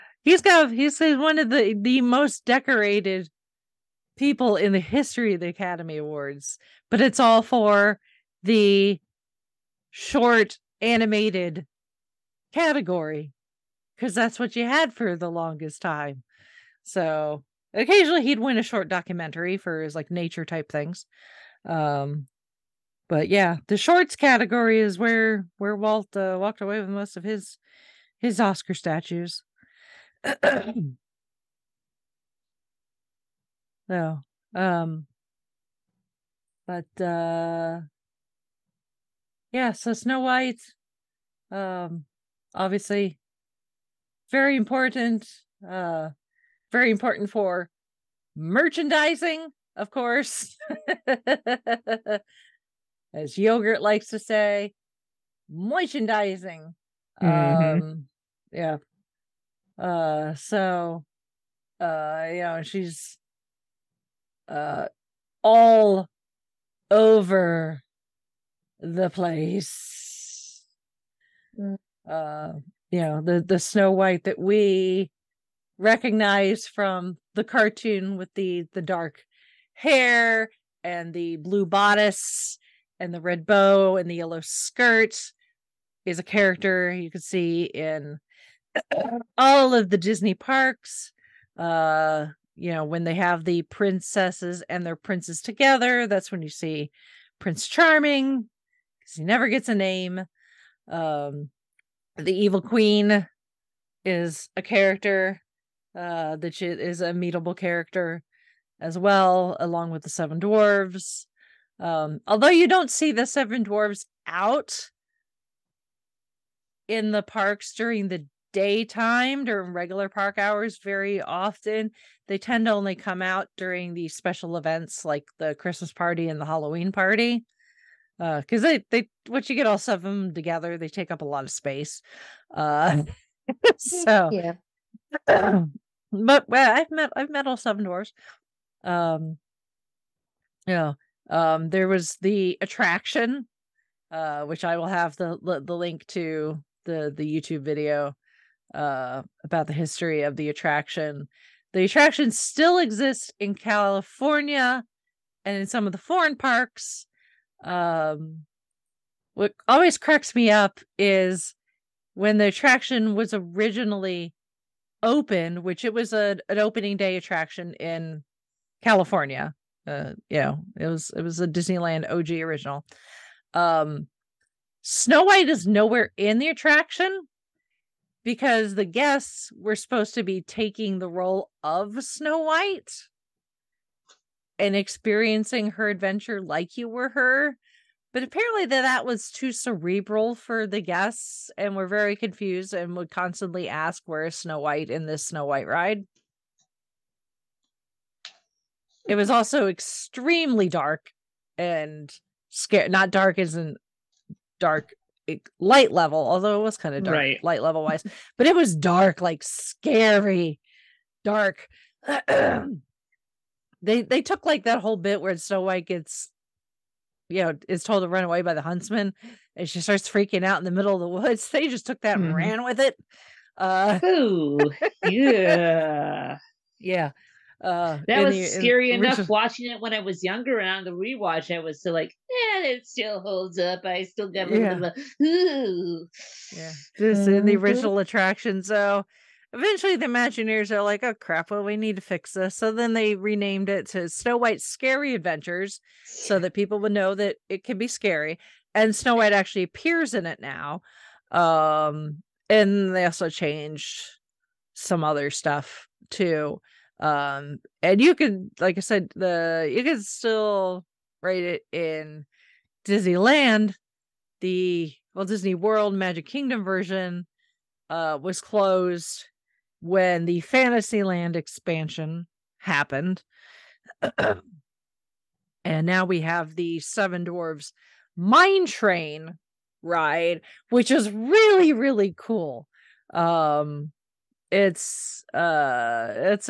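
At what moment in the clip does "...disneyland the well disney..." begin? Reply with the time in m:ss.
4:22.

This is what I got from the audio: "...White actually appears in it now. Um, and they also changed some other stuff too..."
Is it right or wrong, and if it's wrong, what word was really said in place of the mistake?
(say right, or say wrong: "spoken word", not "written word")
right.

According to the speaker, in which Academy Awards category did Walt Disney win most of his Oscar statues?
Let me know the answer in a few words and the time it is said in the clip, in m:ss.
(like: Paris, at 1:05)
Short animated, at 0:09.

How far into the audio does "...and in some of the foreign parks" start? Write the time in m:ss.
2:35.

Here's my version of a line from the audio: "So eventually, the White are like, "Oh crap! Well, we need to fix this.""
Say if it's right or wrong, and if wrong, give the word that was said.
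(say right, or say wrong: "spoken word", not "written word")
wrong: "Imagineers", not "White".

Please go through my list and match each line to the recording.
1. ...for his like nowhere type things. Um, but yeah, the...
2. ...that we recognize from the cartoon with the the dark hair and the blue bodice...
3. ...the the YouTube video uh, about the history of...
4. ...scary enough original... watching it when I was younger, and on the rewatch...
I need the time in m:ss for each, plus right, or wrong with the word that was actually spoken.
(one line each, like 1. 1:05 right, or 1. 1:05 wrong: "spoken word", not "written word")
1. 0:19 wrong: "nature", not "nowhere"
2. 1:14 right
3. 2:26 right
4. 3:48 right.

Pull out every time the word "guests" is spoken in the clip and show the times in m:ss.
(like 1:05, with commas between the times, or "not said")
2:58, 3:10.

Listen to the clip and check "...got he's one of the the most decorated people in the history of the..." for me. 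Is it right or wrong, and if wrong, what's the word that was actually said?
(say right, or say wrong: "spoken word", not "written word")
right.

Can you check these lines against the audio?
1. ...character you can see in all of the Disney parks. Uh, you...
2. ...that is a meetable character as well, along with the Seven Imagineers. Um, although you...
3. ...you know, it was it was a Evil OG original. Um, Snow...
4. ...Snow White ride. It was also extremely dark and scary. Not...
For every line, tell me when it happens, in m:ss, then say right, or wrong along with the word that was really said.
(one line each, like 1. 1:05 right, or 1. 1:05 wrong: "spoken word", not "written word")
1. 1:26 right
2. 1:46 wrong: "Dwarves", not "Imagineers"
3. 2:50 wrong: "Disneyland", not "Evil"
4. 3:15 right.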